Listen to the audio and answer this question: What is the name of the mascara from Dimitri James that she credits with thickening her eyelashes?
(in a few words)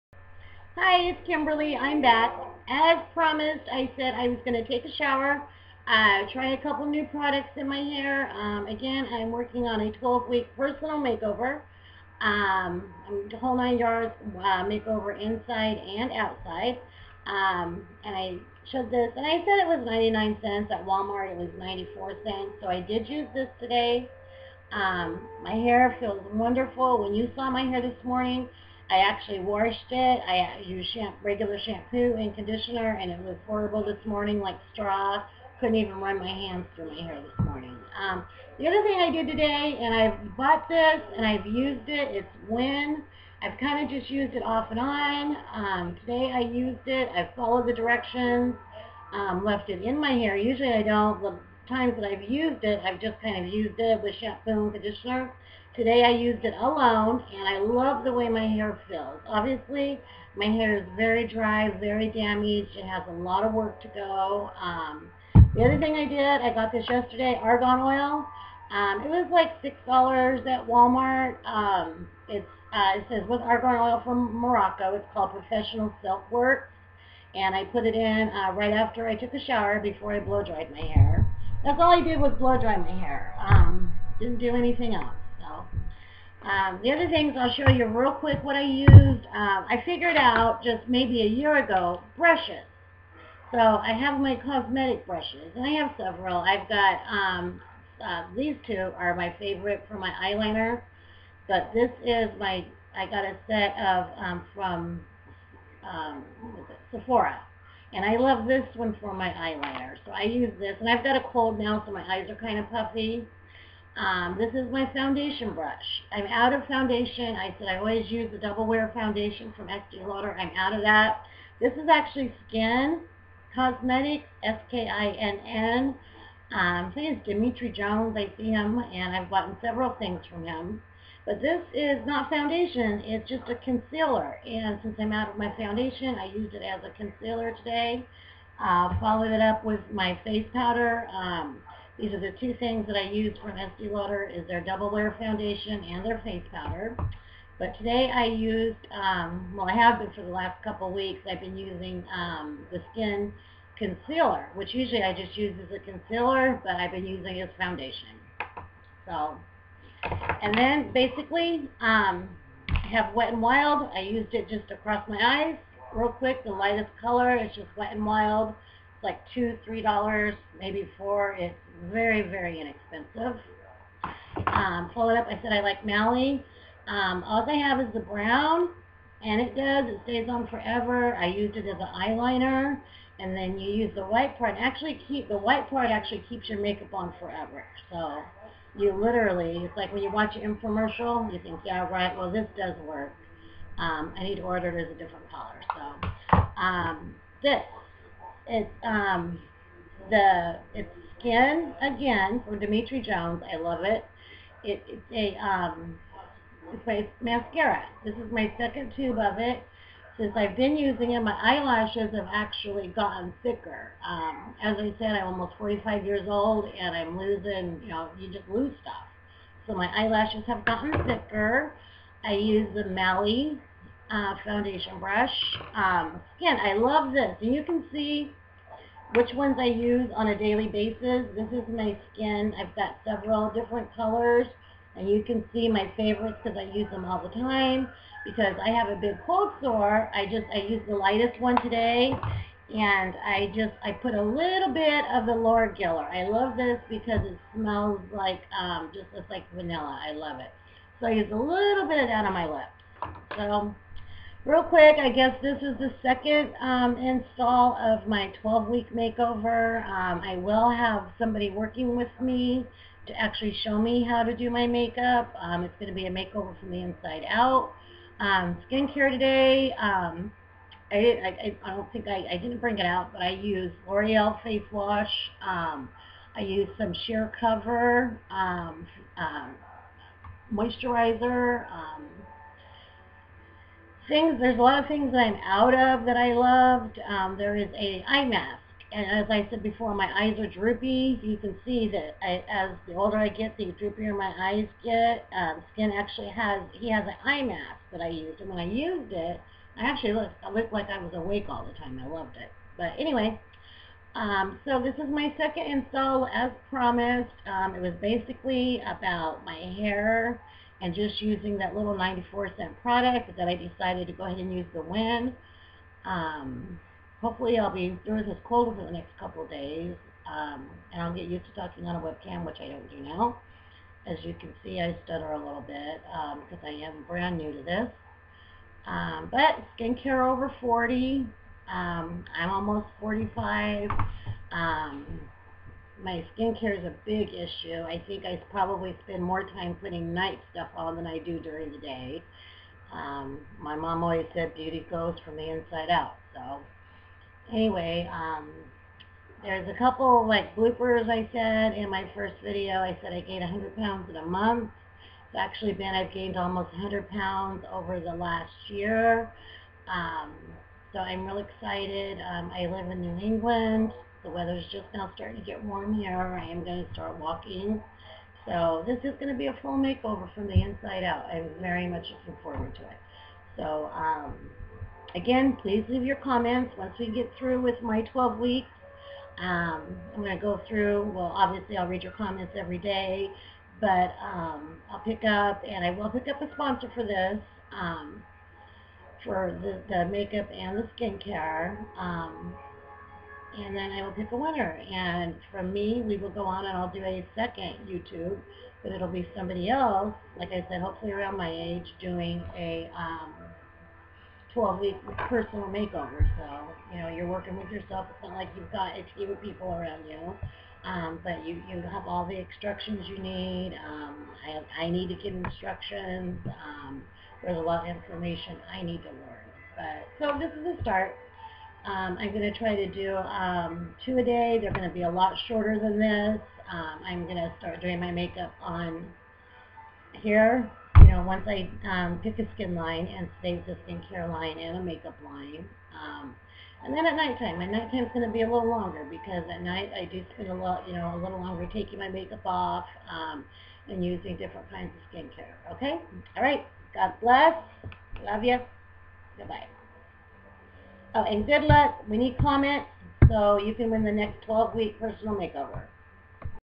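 Skin Again.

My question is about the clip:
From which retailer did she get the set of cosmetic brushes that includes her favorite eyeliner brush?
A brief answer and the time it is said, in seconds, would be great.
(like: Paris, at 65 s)
Sephora, at 106 s.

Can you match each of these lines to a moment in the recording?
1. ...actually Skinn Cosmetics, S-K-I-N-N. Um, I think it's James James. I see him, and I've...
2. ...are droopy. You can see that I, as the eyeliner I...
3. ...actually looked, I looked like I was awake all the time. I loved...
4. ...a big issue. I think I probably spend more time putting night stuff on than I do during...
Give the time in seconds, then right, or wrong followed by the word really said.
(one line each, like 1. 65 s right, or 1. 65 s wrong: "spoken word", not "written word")
1. 121 s wrong: "Dimitri", not "James"
2. 290 s wrong: "older", not "eyeliner"
3. 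299 s right
4. 336 s right.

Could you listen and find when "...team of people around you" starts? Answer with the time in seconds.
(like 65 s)
409 s.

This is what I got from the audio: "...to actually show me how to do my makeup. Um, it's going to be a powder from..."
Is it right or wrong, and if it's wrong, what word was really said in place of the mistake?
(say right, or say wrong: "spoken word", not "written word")
wrong: "makeover", not "powder".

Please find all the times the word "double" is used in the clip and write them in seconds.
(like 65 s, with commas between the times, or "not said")
118 s, 144 s.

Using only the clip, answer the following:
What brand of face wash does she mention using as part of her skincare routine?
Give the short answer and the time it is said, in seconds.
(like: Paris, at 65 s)
L'Oreal, at 273 s.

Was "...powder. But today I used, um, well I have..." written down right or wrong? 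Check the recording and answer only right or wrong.
right.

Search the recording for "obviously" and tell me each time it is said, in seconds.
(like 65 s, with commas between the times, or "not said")
59 s, 381 s.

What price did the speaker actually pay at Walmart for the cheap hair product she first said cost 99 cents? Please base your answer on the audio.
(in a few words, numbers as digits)
94 cents.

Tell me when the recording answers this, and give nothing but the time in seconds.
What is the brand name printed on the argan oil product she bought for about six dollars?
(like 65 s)
75 s.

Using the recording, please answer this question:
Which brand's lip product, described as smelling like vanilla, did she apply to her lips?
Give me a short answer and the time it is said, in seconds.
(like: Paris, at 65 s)
Laura Geller, at 245 s.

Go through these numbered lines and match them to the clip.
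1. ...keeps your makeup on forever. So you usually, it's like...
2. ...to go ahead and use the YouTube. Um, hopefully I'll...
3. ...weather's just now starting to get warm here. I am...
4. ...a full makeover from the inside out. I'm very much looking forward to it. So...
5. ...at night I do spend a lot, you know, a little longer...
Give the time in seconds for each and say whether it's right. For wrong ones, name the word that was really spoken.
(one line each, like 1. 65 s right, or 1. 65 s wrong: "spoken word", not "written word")
1. 186 s wrong: "literally", not "usually"
2. 314 s wrong: "Wen", not "YouTube"
3. 364 s right
4. 369 s right
5. 439 s right.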